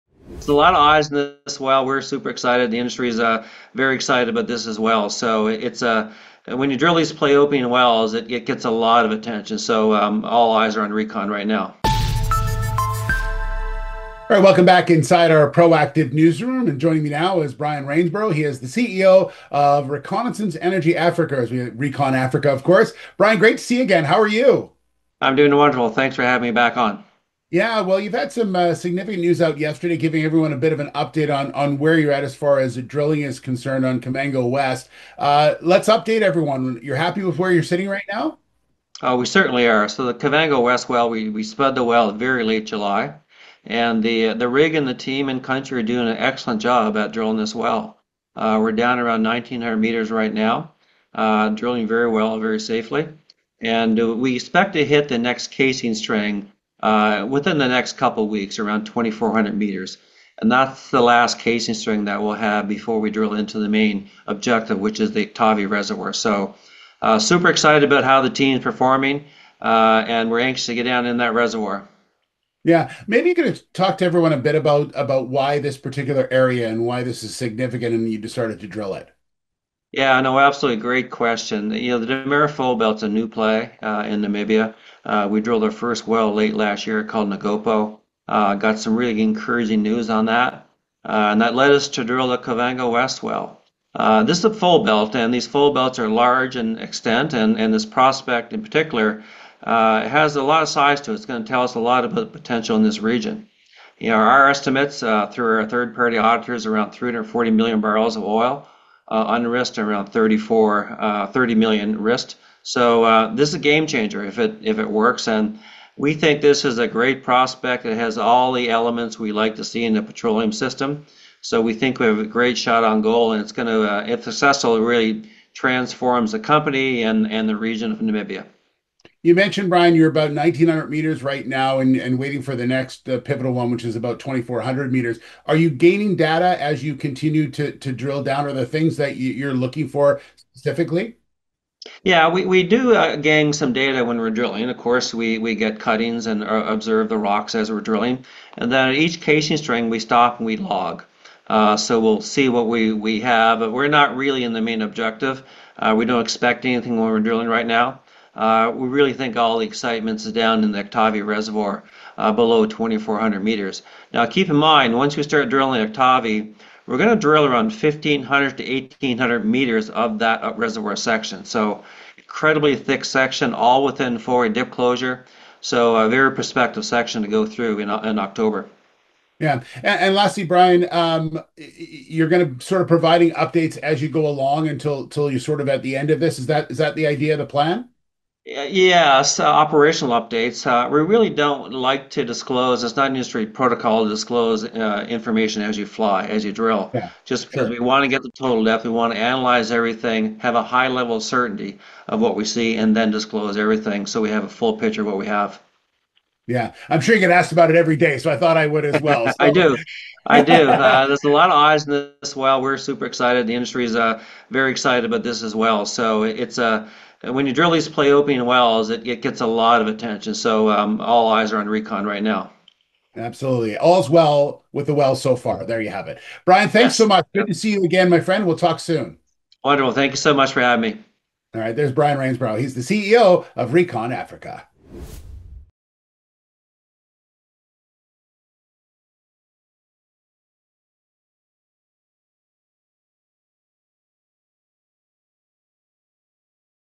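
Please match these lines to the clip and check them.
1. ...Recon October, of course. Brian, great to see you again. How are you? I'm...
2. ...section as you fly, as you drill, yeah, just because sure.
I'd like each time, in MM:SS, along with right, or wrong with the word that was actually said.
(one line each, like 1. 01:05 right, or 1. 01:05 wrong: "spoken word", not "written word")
1. 00:21 wrong: "Africa", not "October"
2. 03:15 wrong: "information", not "section".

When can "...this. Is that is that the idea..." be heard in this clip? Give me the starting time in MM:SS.
03:06.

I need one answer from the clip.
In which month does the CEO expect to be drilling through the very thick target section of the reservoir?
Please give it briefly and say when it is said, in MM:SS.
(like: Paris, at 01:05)
October, at 02:58.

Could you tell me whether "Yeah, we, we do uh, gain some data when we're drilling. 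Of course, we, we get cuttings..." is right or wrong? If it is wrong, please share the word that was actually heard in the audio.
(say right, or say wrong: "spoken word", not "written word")
right.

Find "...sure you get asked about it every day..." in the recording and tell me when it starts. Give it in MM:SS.
03:27.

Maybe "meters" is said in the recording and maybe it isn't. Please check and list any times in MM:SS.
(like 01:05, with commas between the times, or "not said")
00:49, 00:59, 02:10, 02:14, 02:43, 02:49.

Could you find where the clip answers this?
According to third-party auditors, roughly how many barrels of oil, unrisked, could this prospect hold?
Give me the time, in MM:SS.
01:46.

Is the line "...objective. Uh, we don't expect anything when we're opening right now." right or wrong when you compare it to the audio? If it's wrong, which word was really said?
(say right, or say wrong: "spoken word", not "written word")
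wrong: "drilling", not "opening".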